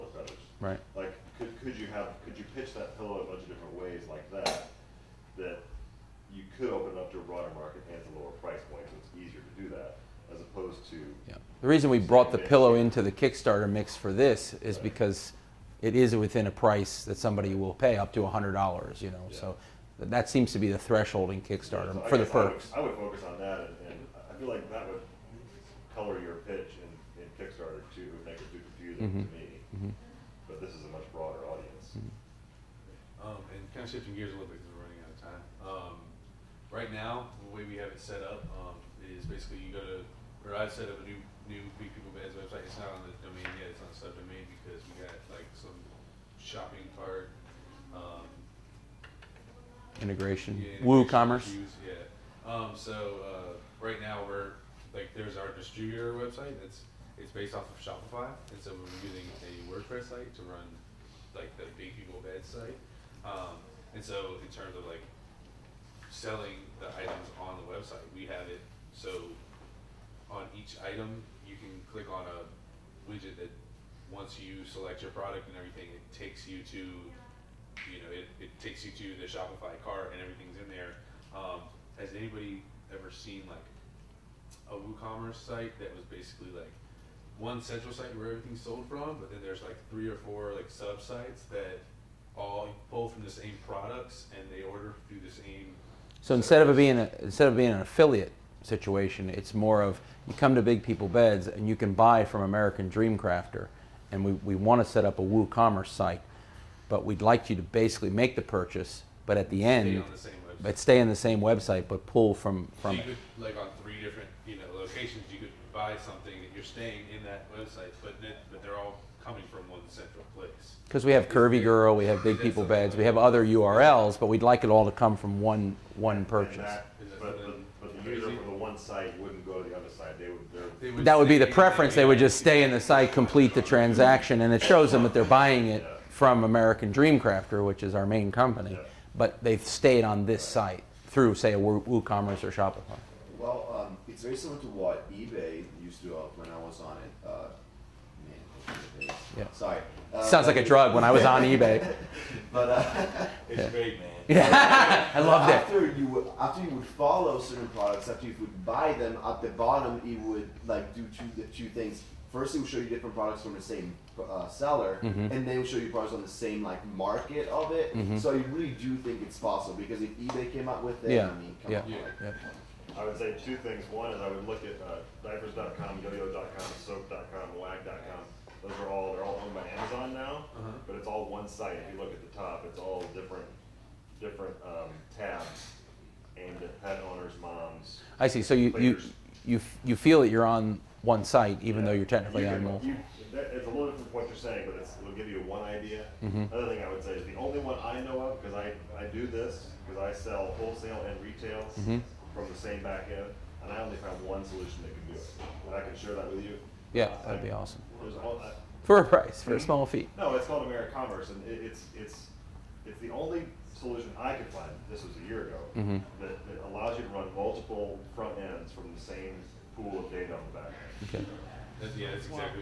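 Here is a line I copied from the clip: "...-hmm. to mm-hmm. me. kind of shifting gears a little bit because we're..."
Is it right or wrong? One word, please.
right.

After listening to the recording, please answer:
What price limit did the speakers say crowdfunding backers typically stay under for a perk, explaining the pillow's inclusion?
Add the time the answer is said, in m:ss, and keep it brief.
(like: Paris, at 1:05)
$100, at 0:18.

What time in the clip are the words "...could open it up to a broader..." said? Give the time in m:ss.
0:06.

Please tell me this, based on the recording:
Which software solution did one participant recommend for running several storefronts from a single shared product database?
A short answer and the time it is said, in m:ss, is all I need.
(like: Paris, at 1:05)
AmeriCommerce, at 3:30.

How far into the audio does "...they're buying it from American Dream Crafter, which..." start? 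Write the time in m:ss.
2:15.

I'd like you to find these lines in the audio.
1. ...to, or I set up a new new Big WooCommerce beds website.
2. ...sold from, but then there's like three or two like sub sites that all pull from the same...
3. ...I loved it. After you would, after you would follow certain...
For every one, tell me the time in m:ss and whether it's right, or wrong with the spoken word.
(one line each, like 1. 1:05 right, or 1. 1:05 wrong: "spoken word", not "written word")
1. 0:39 wrong: "People", not "WooCommerce"
2. 1:28 wrong: "four", not "two"
3. 2:35 right.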